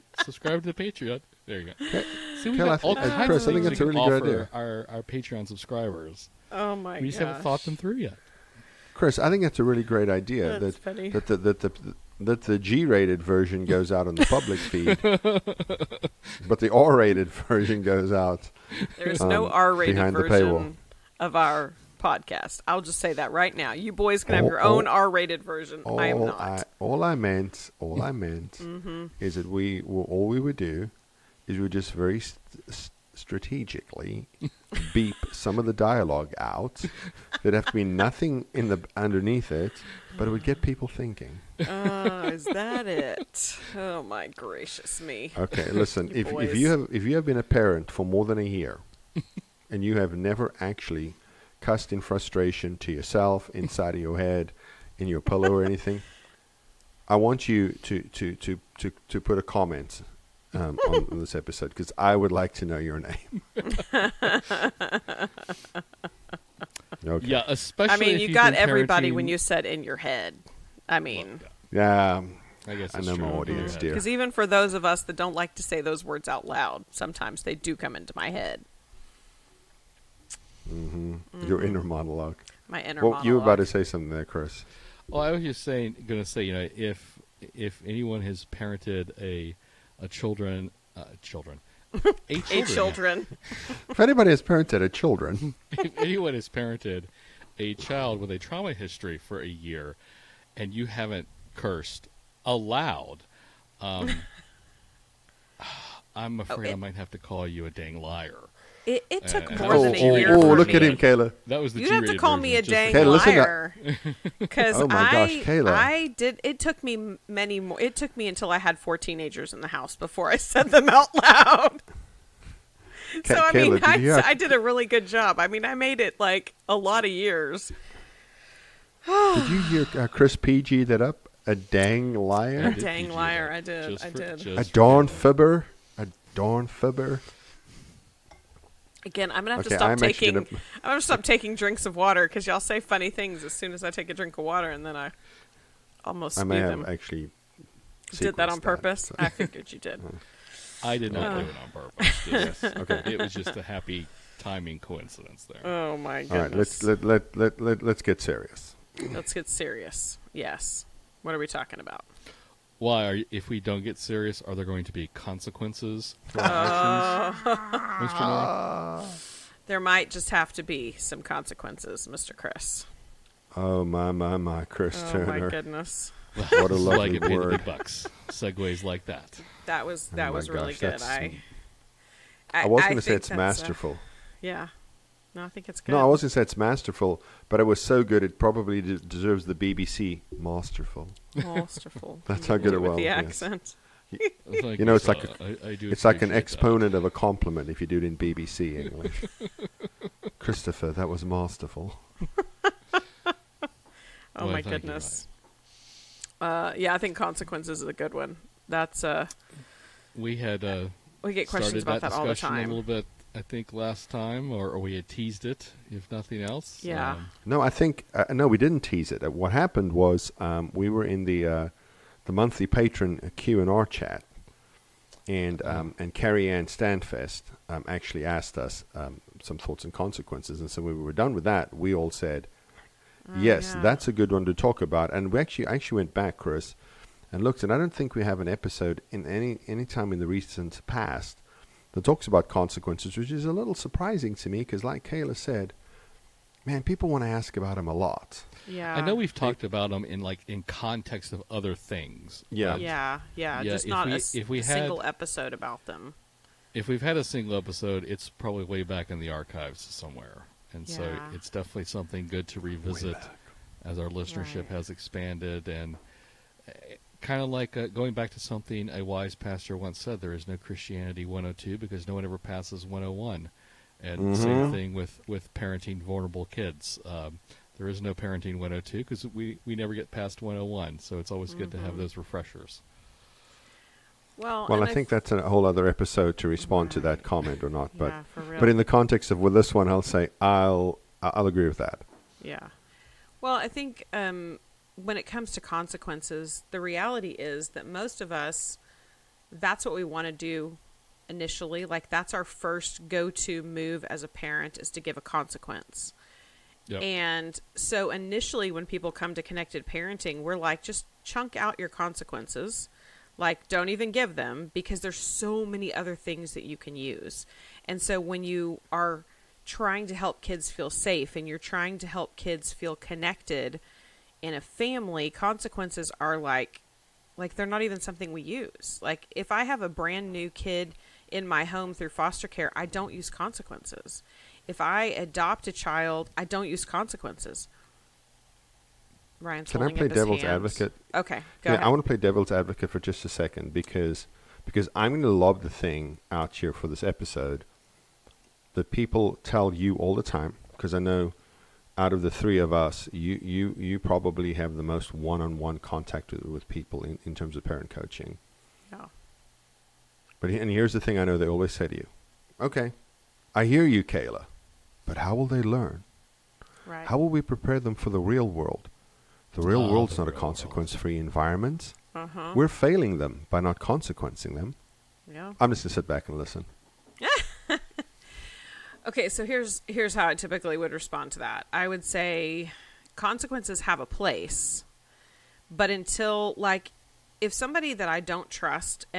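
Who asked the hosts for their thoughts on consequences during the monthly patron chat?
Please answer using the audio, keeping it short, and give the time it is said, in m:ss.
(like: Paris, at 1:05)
Carrie Ann Standfest, at 3:46.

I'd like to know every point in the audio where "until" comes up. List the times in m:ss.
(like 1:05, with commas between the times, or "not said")
1:58, 6:25.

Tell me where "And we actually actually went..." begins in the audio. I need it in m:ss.
3:55.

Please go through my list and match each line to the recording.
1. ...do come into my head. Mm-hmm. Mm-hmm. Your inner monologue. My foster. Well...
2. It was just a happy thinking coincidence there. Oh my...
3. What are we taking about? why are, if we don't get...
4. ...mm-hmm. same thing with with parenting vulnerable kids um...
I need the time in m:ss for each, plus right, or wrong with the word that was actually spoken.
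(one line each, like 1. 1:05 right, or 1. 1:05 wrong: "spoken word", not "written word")
1. 1:17 wrong: "inner", not "foster"
2. 2:33 wrong: "timing", not "thinking"
3. 2:41 wrong: "talking", not "taking"
4. 4:34 right.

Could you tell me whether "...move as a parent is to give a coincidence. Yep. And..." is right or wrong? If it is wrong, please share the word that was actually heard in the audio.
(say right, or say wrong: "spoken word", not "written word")
wrong: "consequence", not "coincidence".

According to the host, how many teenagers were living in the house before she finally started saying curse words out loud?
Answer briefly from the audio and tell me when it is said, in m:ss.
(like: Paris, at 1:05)
4, at 1:58.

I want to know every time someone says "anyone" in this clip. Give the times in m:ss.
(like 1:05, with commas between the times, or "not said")
1:27, 1:35.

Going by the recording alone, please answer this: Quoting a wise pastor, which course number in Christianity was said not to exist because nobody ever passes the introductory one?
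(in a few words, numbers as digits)
102.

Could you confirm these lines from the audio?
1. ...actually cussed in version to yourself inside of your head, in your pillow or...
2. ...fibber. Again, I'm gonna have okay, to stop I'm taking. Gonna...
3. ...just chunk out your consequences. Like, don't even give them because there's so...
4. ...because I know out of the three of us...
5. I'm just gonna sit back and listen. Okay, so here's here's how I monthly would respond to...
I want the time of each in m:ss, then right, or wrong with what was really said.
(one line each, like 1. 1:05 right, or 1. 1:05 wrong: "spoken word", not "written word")
1. 0:50 wrong: "frustration", not "version"
2. 2:16 right
3. 5:10 right
4. 5:50 right
5. 6:15 wrong: "typically", not "monthly".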